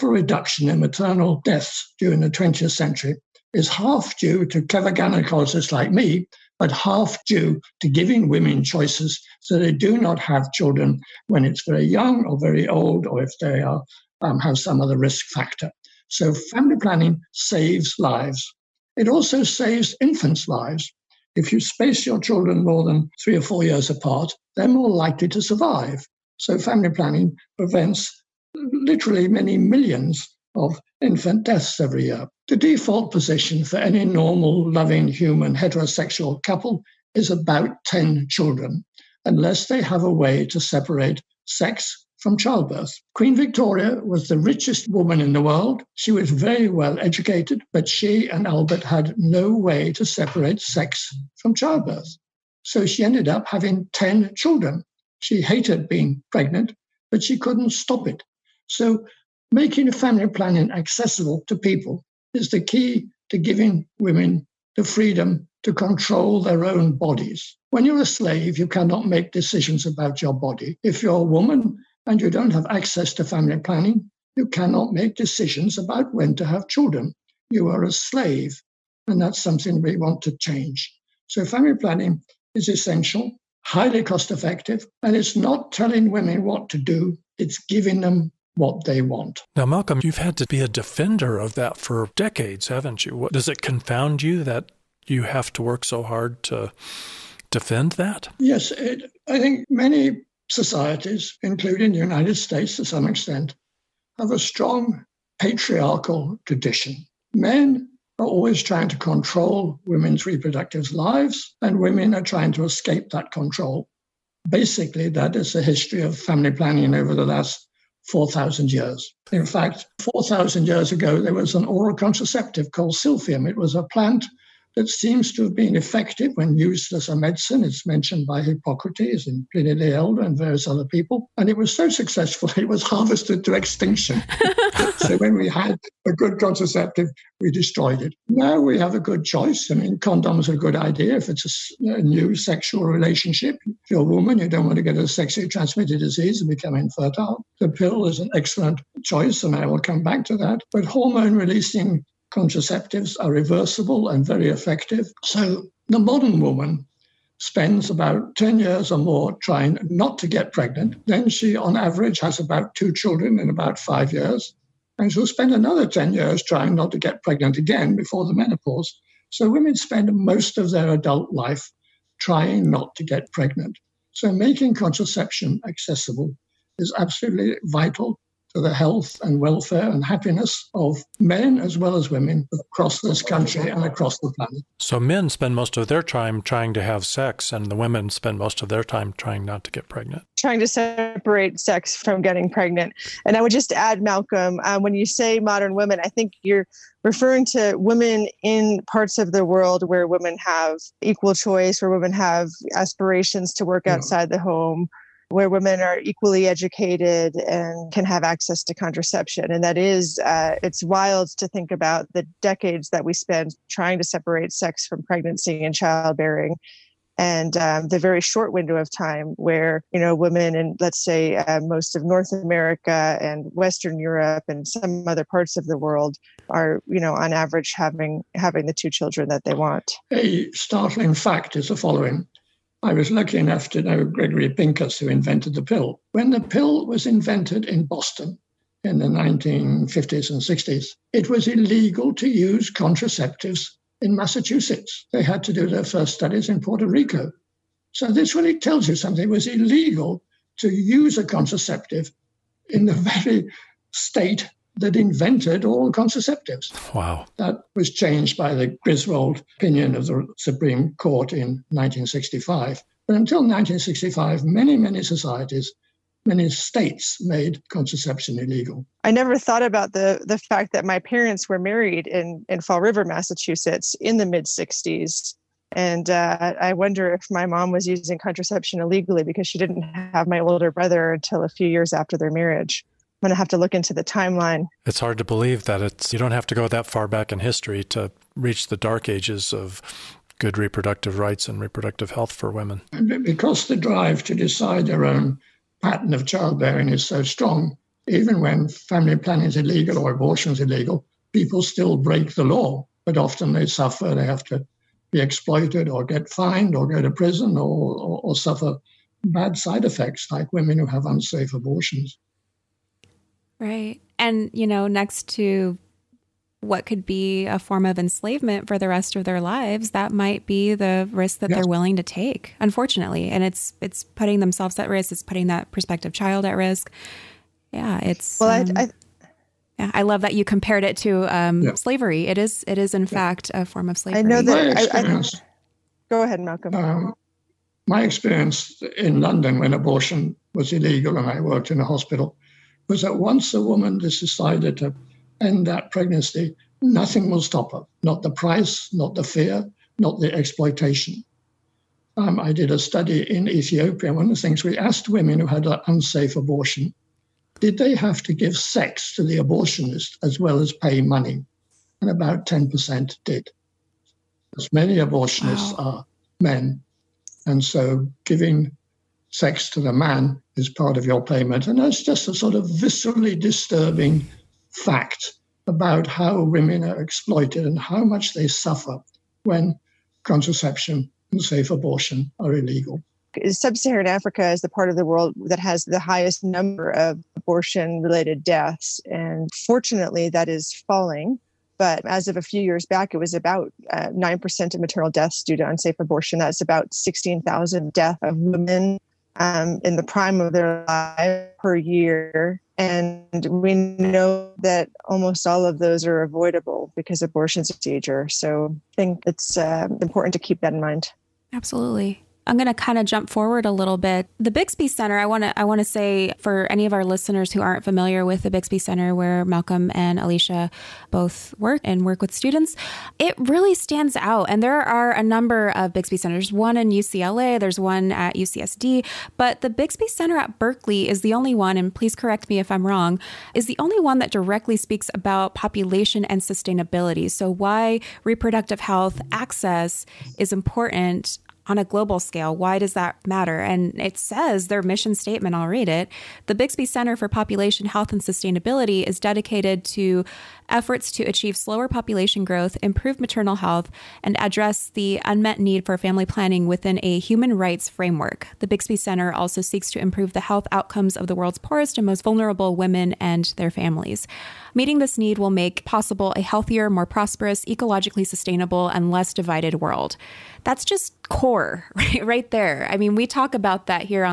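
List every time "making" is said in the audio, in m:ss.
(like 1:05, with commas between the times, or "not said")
0:59, 2:54.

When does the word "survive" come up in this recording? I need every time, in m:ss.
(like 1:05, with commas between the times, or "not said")
0:25.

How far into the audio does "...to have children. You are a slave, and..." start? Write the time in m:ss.
1:16.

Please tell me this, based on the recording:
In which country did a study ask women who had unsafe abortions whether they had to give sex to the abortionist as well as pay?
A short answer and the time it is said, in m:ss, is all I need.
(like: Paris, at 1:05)
Ethiopia, at 5:53.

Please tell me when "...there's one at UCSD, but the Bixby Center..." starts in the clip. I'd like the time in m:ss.
7:07.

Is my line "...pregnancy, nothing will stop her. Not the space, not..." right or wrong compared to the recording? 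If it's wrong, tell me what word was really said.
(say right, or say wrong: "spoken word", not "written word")
wrong: "price", not "space".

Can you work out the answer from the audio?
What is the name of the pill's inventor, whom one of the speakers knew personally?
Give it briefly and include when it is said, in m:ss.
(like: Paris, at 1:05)
Gregory Pincus, at 3:54.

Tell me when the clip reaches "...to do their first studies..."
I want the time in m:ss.
4:05.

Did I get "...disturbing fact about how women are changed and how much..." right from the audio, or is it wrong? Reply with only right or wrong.
wrong.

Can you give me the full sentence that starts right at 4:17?
That was changed by the Griswold opinion of the Supreme Court in 1965.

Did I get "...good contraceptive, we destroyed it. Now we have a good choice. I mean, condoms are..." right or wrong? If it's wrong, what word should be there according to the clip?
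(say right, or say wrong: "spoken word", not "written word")
right.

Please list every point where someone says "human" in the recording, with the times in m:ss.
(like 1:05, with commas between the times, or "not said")
0:35, 7:37.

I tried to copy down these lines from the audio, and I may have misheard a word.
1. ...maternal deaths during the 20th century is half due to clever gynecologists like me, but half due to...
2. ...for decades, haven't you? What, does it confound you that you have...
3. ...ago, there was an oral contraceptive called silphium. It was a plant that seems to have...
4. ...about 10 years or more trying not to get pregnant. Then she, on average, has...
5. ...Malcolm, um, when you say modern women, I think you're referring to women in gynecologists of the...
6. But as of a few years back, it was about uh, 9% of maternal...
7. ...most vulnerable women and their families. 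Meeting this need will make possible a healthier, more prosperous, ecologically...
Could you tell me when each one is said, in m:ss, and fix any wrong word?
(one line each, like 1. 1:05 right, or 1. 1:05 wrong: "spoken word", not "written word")
1. 0:00 right
2. 1:31 right
3. 2:00 right
4. 2:37 right
5. 3:14 wrong: "parts", not "gynecologists"
6. 6:31 right
7. 7:42 right.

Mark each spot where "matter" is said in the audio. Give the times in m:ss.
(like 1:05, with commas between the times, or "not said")
7:23.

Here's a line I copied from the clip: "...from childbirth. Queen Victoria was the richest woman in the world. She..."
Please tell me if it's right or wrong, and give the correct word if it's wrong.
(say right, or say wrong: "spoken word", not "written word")
right.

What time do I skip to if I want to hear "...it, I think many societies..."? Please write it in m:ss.
1:38.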